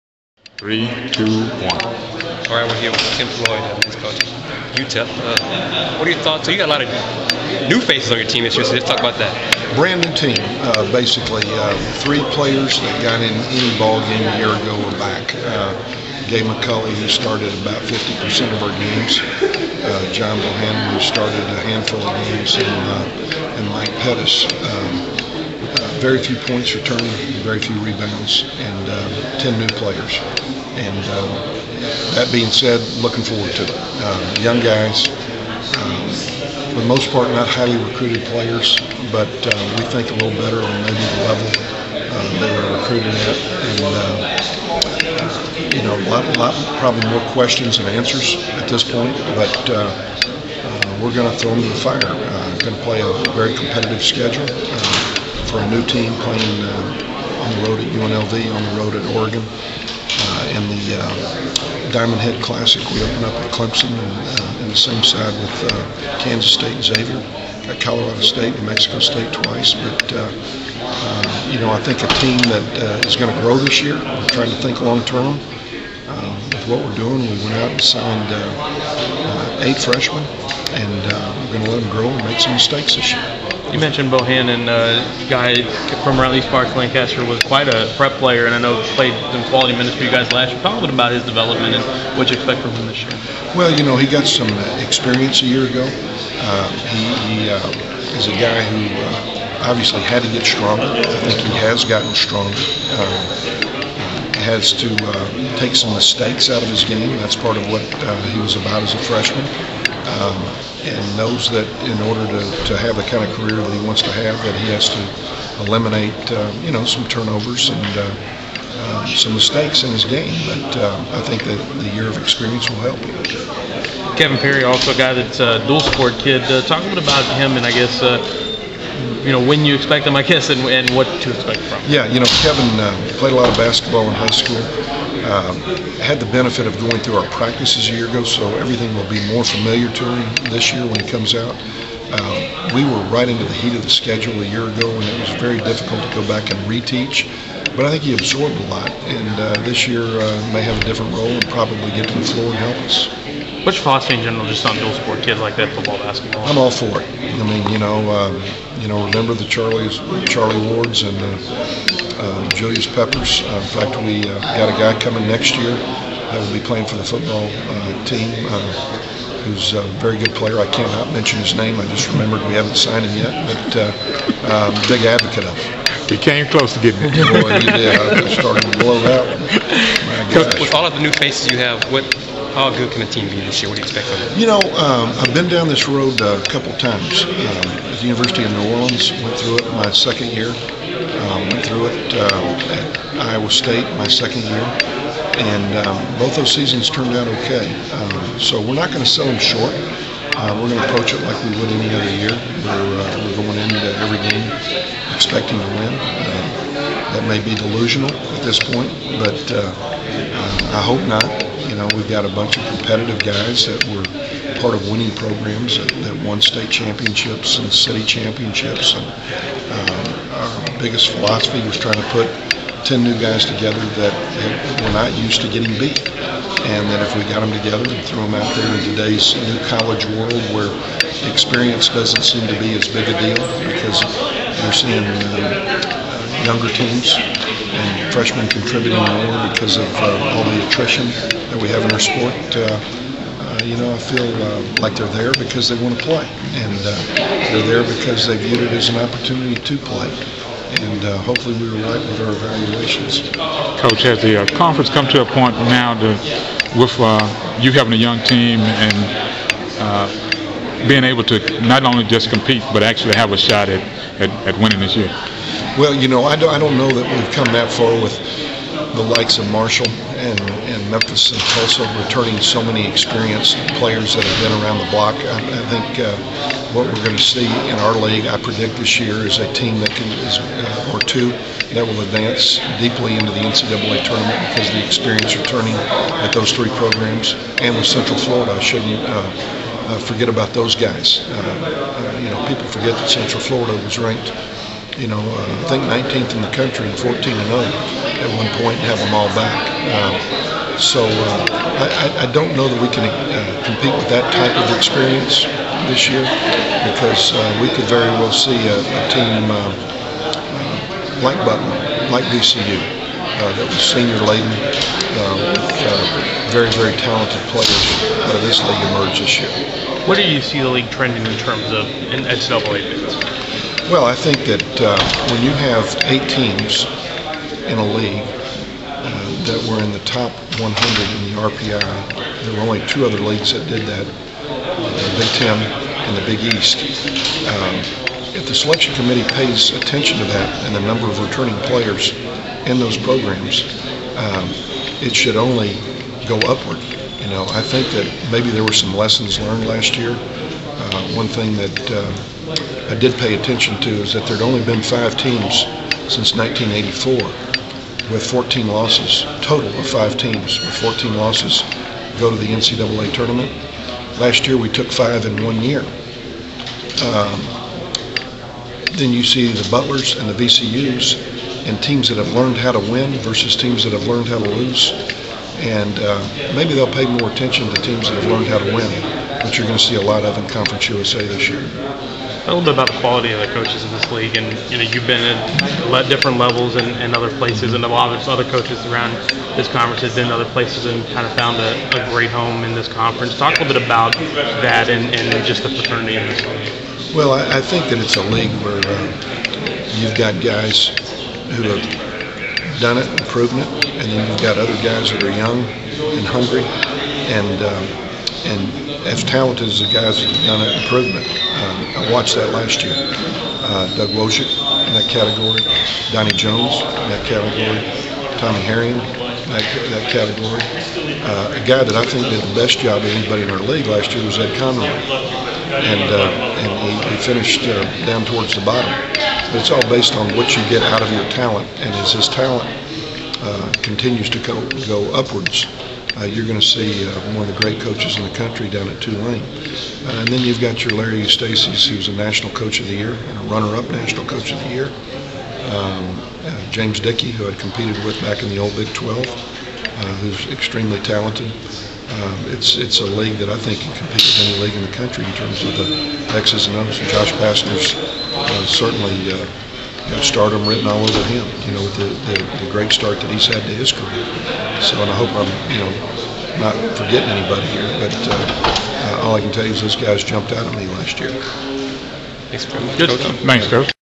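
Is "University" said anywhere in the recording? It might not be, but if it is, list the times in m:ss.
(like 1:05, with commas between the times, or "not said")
3:08.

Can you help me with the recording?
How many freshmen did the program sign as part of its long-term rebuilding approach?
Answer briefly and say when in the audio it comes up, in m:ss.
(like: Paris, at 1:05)
8, at 1:19.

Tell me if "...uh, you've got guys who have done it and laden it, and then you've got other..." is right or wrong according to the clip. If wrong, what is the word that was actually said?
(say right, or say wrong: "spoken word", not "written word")
wrong: "proven", not "laden".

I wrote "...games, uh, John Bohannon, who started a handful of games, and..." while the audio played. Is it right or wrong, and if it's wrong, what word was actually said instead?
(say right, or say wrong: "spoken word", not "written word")
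right.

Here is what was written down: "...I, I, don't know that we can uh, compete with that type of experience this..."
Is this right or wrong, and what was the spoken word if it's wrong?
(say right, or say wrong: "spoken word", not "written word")
right.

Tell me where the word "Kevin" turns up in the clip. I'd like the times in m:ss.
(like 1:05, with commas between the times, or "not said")
2:04, 2:12.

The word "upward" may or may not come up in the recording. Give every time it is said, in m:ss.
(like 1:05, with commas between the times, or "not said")
5:46, 7:15.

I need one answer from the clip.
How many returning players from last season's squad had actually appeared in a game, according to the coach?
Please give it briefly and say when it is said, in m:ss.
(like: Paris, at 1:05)
3, at 0:12.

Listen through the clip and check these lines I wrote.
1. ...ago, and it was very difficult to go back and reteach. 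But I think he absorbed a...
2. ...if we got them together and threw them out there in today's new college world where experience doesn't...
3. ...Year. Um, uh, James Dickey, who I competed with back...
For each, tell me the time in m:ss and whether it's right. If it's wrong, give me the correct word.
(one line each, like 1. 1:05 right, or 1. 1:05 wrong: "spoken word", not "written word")
1. 2:24 right
2. 3:47 right
3. 7:24 right.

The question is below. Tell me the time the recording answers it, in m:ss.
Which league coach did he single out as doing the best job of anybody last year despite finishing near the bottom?
7:04.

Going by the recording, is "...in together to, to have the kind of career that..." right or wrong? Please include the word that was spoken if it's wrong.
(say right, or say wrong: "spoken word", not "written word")
wrong: "order", not "together".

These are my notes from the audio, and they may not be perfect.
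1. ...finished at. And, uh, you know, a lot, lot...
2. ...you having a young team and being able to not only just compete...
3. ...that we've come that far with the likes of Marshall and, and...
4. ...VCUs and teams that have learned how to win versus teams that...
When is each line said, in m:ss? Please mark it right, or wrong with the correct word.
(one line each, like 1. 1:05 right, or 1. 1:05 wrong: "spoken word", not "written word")
1. 0:42 wrong: "recruited", not "finished"
2. 4:17 right
3. 4:26 right
4. 6:10 right.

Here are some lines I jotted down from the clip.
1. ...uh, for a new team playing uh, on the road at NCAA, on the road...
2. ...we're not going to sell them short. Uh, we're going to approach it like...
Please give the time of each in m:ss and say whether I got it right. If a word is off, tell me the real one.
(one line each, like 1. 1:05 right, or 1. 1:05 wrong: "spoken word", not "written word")
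1. 0:54 wrong: "UNLV", not "NCAA"
2. 3:18 right.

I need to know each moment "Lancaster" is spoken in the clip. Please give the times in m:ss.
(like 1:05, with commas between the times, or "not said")
1:26.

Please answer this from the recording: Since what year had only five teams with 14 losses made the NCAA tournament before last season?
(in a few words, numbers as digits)
1984.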